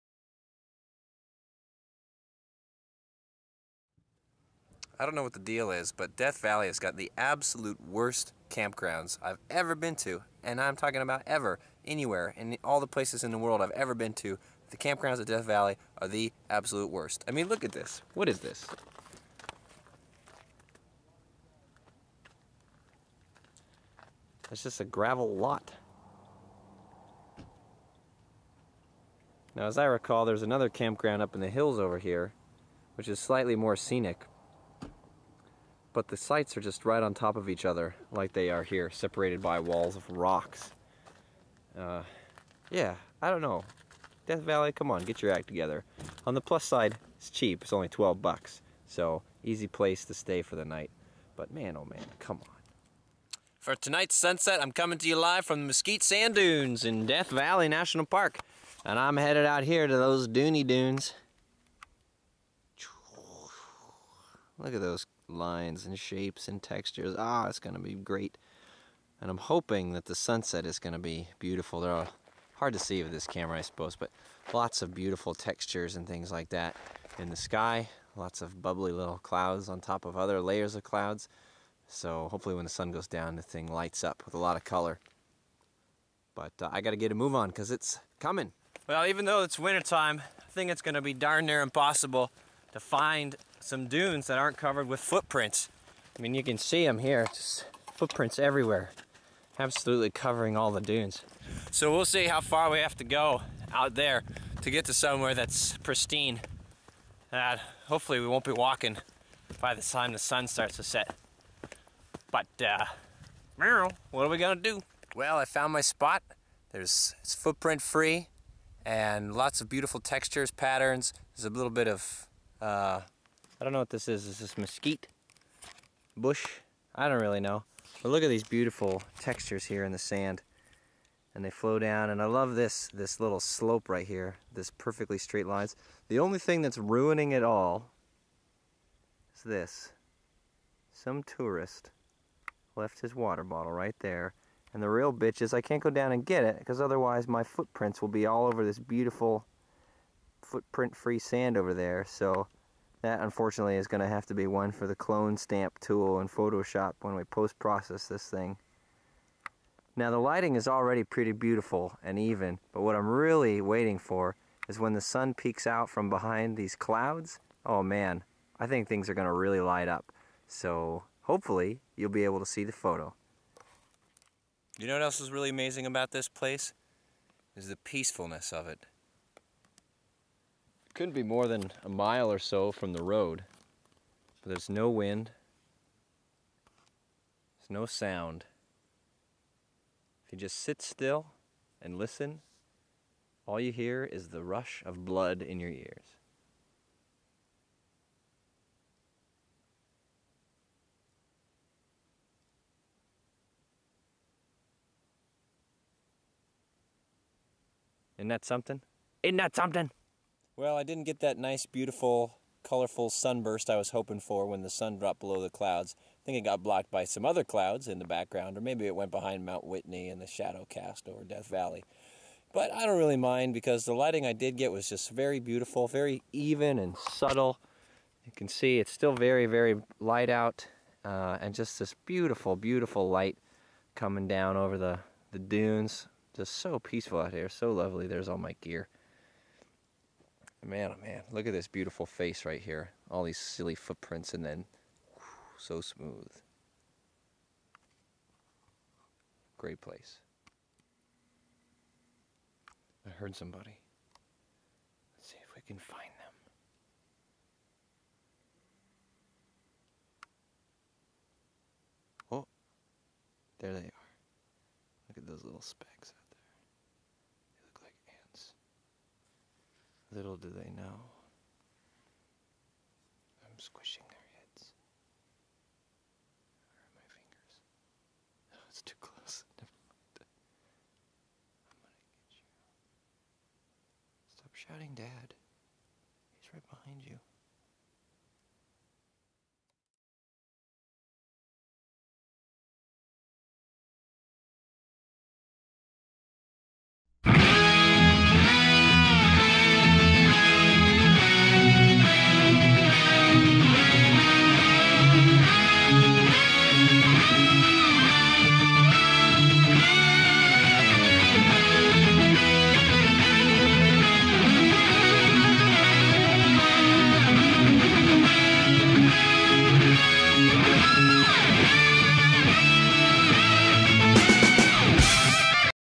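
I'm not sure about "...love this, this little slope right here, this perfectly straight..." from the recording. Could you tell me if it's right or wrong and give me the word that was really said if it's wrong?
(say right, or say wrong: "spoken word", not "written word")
right.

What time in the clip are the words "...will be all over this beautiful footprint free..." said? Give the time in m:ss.
2:28.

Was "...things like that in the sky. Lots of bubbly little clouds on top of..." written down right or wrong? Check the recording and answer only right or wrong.
right.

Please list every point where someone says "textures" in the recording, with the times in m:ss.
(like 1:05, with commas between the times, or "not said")
1:06, 1:15, 1:59, 2:09.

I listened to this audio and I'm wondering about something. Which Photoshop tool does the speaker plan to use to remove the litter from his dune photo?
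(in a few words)
Clone stamp tool.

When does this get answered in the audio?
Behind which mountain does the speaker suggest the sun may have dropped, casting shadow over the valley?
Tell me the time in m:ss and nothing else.
3:39.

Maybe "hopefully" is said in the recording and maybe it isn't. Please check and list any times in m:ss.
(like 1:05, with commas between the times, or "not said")
1:22, 1:47, 2:51.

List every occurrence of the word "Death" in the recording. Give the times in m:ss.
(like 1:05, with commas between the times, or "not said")
0:06, 0:15, 0:44, 0:57, 3:41.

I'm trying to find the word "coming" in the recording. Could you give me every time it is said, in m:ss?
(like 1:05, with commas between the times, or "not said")
0:54, 1:28, 3:53.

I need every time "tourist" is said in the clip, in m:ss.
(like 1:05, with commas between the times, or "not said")
2:21.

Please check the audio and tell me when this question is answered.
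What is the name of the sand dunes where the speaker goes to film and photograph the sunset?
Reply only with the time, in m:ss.
0:55.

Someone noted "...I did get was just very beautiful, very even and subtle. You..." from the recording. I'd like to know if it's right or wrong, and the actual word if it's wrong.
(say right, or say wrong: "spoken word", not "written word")
right.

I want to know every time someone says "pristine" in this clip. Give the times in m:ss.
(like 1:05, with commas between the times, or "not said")
1:45.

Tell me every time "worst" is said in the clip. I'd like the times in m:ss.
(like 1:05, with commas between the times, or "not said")
0:07, 0:16.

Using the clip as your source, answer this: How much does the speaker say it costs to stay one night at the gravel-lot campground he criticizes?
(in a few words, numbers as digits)
$12.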